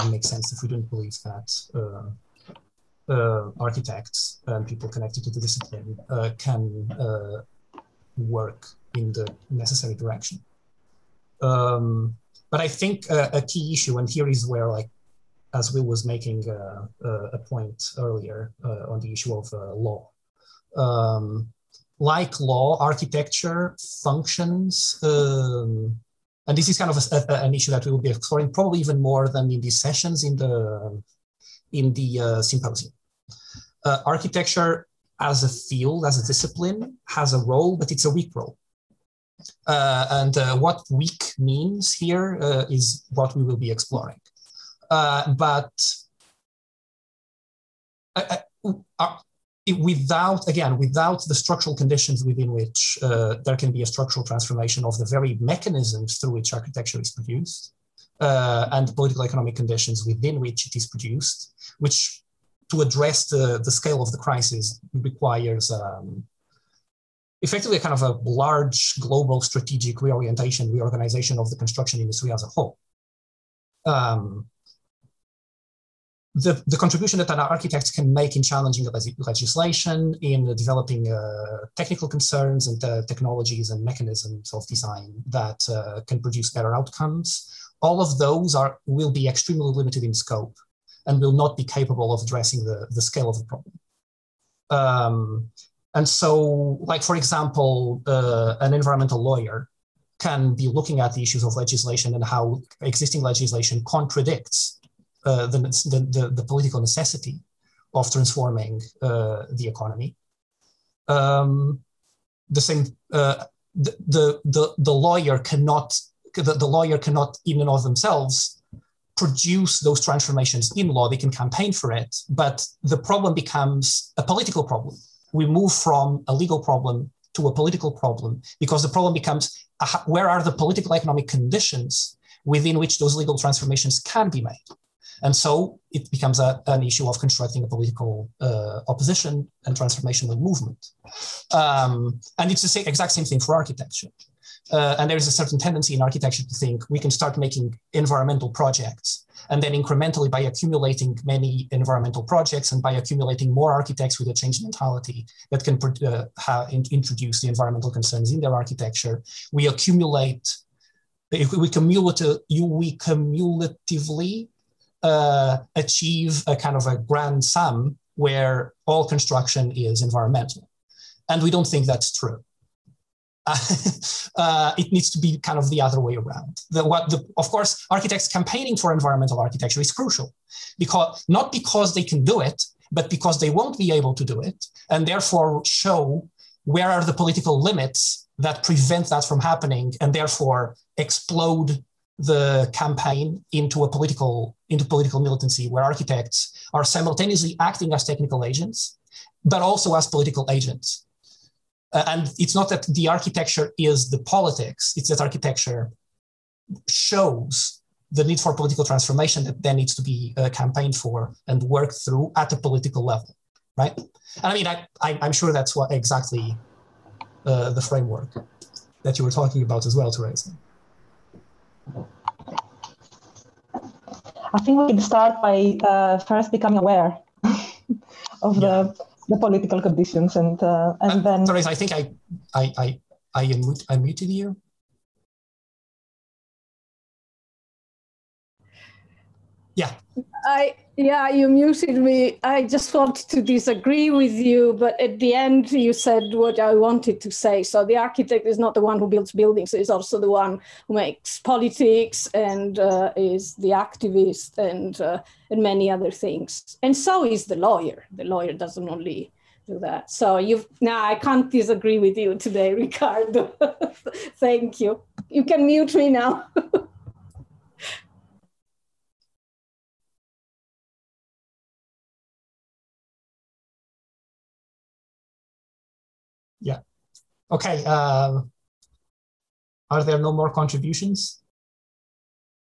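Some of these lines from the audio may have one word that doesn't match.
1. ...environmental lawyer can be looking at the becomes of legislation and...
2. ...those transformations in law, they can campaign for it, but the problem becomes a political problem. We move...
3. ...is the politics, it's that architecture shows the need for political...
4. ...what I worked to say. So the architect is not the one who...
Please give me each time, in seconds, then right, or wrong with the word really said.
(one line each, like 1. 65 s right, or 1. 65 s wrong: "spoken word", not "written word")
1. 98 s wrong: "issues", not "becomes"
2. 119 s right
3. 203 s right
4. 246 s wrong: "wanted", not "worked".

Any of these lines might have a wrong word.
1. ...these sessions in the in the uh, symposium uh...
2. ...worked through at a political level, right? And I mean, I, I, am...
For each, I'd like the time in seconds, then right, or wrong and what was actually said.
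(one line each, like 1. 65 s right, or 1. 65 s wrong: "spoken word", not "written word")
1. 29 s right
2. 211 s right.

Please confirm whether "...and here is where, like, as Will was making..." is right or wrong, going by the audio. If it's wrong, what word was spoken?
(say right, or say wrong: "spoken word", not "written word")
right.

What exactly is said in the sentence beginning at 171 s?
And we don't think that's true.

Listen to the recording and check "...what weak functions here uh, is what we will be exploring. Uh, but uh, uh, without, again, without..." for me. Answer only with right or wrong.
wrong.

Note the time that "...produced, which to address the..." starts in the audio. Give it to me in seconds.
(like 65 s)
60 s.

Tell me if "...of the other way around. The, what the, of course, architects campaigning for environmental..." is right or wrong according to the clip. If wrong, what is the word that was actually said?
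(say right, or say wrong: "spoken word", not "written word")
right.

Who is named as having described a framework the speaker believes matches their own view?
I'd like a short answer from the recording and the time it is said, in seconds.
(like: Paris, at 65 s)
Teresa, at 220 s.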